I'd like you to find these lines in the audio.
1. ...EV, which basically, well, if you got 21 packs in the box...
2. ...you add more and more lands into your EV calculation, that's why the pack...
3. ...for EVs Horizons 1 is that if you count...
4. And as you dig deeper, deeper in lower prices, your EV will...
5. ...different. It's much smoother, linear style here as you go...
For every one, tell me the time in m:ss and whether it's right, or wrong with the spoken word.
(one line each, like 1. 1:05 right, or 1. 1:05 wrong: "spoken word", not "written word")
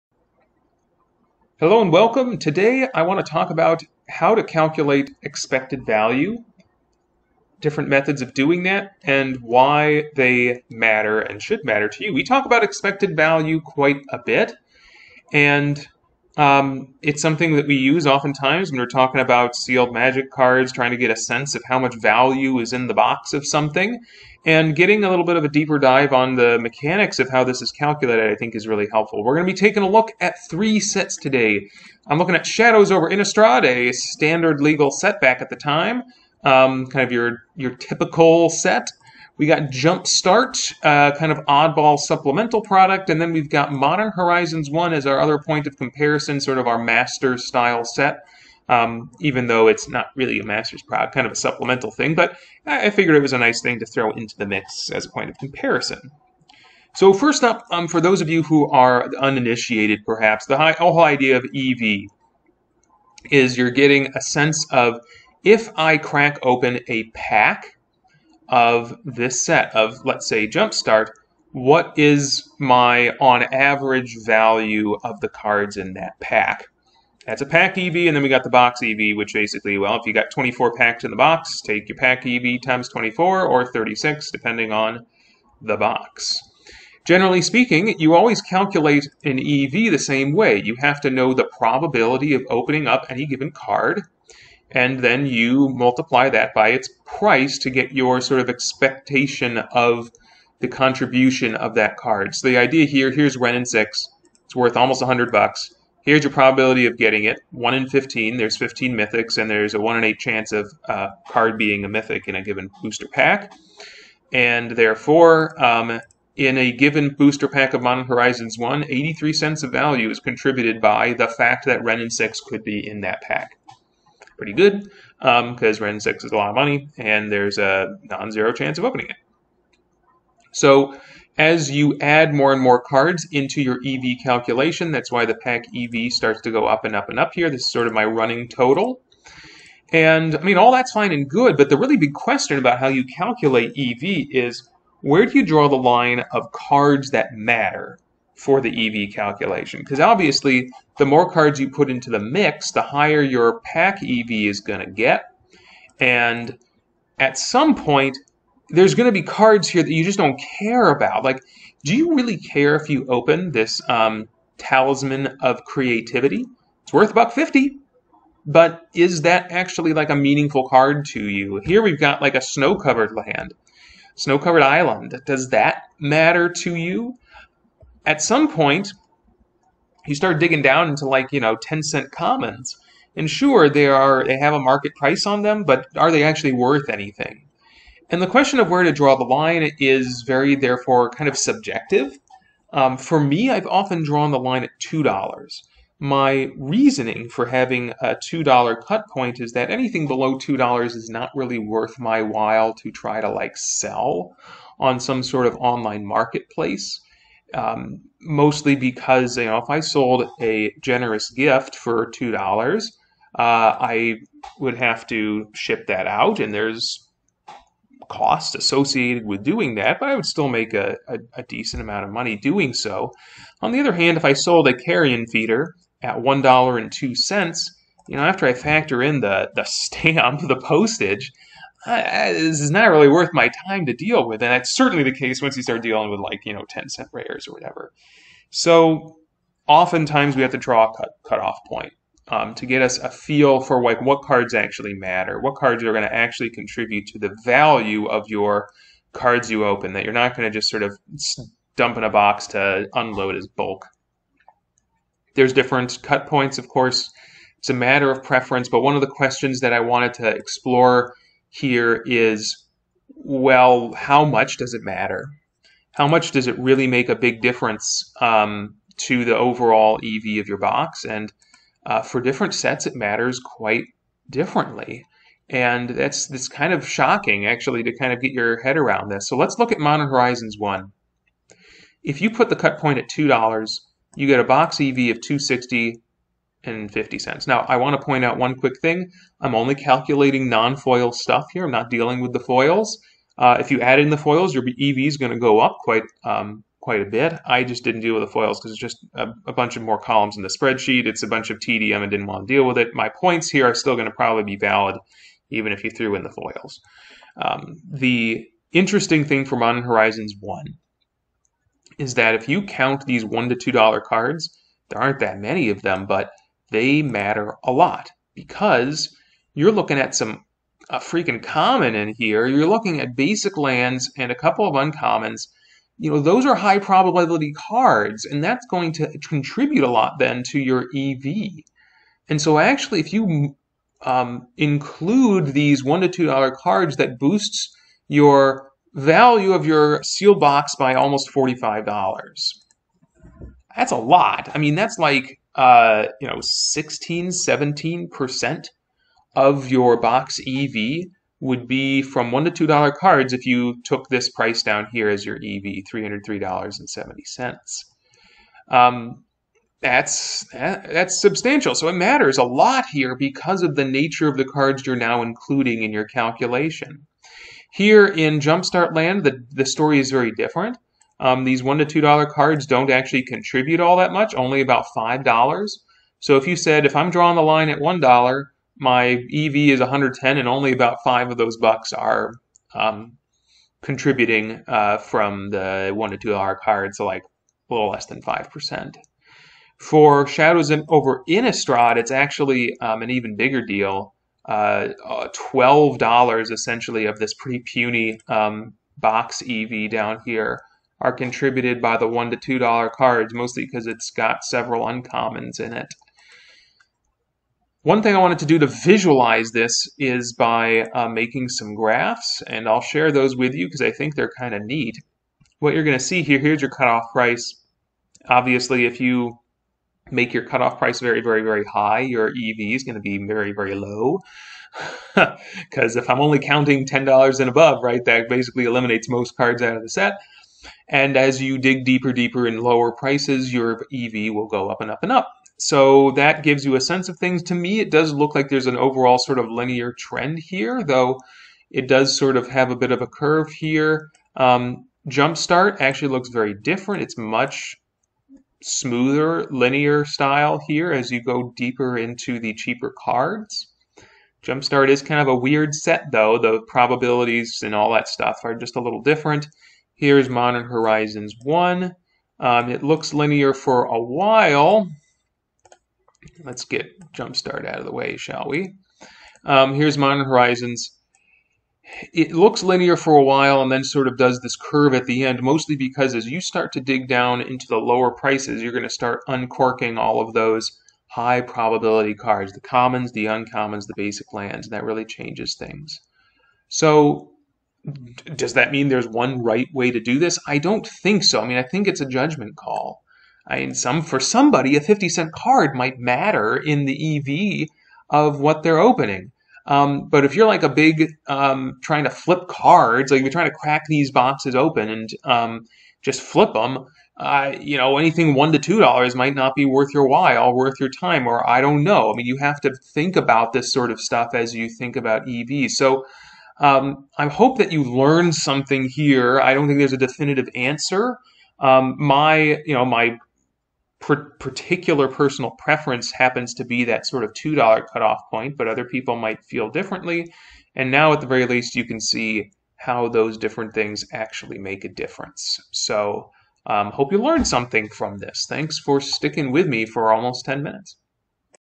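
1. 1:18 wrong: "24", not "21"
2. 2:11 wrong: "cards", not "lands"
3. 5:09 wrong: "Modern", not "EVs"
4. 7:10 right
5. 7:26 right.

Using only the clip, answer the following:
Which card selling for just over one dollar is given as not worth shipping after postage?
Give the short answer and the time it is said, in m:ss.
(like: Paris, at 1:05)
Carrion Feeder, at 3:44.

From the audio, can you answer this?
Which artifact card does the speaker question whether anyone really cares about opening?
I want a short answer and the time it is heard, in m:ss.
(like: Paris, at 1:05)
Talisman of Creativity, at 2:44.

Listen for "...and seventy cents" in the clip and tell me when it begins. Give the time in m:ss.
5:56.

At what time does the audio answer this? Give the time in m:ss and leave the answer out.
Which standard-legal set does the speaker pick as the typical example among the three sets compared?
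0:32.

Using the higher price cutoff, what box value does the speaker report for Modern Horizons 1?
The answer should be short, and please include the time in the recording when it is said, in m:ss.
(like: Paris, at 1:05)
$260.50, at 4:45.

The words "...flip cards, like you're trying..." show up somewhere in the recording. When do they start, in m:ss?
8:22.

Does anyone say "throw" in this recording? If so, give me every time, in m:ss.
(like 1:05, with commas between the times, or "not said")
0:53.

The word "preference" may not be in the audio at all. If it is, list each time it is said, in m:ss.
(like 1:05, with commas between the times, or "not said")
4:18, 8:45.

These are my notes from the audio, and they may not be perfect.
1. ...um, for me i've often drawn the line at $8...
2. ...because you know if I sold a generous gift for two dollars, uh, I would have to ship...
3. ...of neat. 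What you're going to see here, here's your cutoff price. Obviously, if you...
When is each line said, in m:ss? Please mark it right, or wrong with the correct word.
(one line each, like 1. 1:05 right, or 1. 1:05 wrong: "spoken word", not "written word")
1. 3:12 wrong: "2", not "8"
2. 3:28 right
3. 6:54 right.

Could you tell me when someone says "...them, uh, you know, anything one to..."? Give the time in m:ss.
8:26.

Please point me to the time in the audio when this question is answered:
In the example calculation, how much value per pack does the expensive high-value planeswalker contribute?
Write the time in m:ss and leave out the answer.
1:58.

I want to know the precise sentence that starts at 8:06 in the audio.
So does that mean there's one right way to do this?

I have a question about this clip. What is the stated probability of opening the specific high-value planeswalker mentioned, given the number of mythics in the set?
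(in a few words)
1 in 15.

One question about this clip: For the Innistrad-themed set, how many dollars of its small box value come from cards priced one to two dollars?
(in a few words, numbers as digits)
$12.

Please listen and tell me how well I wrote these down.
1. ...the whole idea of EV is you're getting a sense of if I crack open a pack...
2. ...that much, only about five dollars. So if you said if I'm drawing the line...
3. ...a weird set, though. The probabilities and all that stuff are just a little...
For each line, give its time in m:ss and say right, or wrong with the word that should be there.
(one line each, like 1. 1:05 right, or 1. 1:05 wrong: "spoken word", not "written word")
1. 1:00 right
2. 6:13 right
3. 7:35 right.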